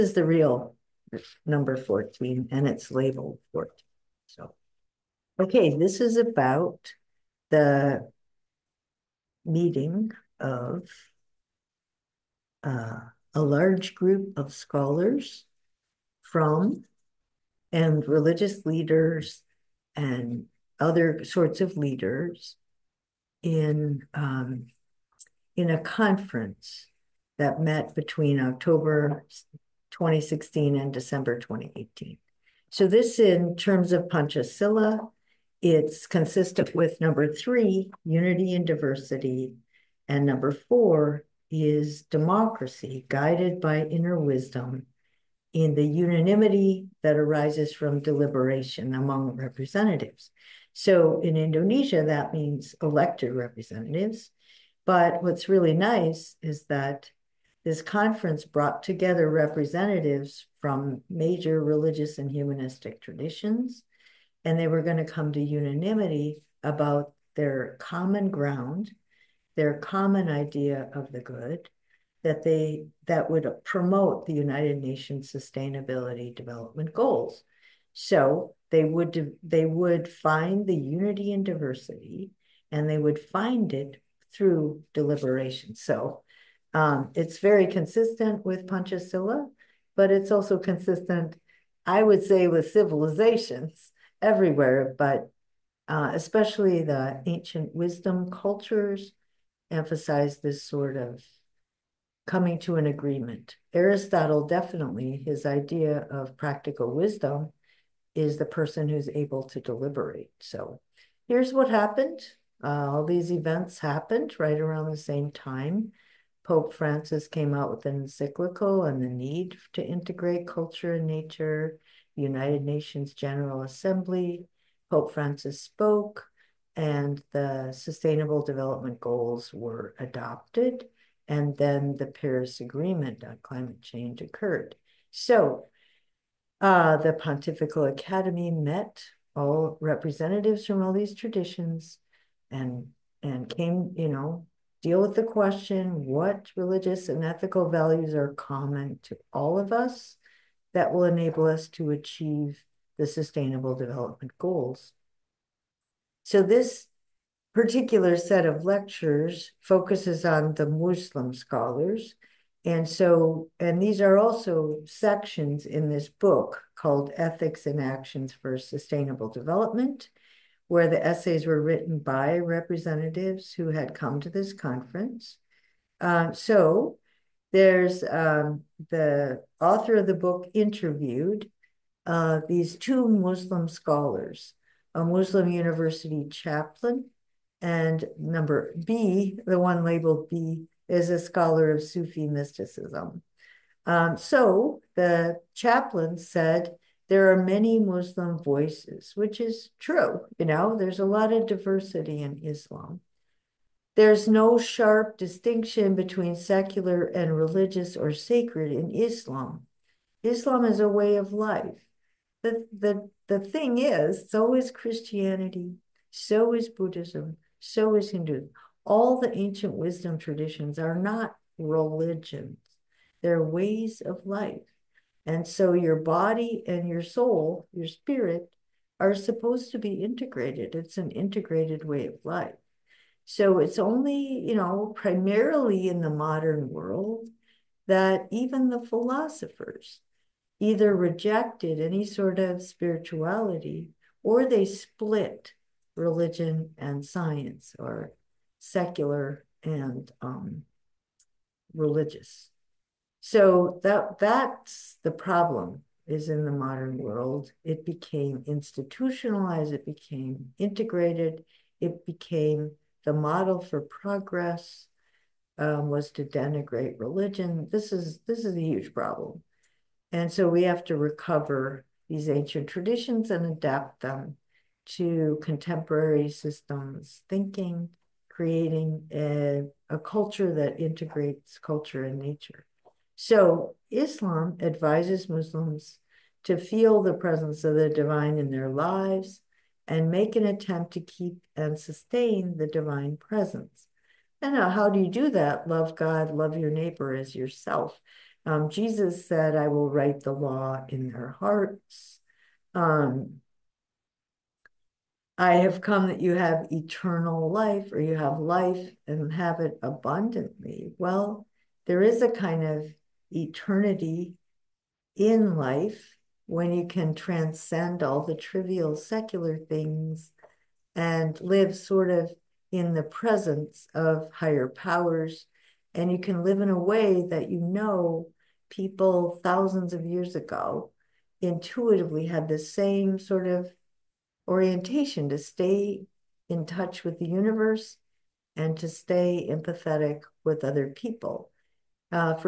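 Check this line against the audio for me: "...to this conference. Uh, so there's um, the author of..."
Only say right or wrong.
right.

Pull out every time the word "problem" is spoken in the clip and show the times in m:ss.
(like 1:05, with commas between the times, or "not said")
4:15, 4:28.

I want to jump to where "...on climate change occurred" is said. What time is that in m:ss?
2:13.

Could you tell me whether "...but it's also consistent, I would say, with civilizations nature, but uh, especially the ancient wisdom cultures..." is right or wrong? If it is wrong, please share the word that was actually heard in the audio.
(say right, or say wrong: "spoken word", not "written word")
wrong: "everywhere", not "nature".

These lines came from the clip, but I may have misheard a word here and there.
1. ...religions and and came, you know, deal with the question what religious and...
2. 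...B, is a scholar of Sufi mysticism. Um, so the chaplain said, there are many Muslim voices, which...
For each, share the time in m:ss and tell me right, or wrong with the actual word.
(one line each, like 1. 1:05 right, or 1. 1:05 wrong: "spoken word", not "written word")
1. 2:21 wrong: "traditions", not "religions"
2. 3:10 right.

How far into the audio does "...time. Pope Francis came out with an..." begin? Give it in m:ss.
1:55.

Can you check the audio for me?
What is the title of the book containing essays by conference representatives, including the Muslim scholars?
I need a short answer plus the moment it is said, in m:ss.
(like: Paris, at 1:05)
Ethics and Actions for Sustainable Development, at 2:47.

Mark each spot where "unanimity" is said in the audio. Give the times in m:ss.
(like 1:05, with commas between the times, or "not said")
0:45, 1:05.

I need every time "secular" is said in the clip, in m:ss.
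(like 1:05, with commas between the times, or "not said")
3:26, 4:08, 5:18.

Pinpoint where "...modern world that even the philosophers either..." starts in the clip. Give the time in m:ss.
3:56.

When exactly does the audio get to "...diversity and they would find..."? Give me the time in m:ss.
1:21.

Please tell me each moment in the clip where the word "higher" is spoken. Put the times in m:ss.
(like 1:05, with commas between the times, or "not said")
5:24.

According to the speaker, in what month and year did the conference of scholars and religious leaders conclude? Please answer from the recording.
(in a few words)
December 2018.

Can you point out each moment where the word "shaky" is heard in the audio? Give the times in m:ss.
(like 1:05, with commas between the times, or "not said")
not said.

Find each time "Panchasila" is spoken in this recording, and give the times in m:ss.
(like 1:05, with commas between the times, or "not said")
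0:34, 1:28.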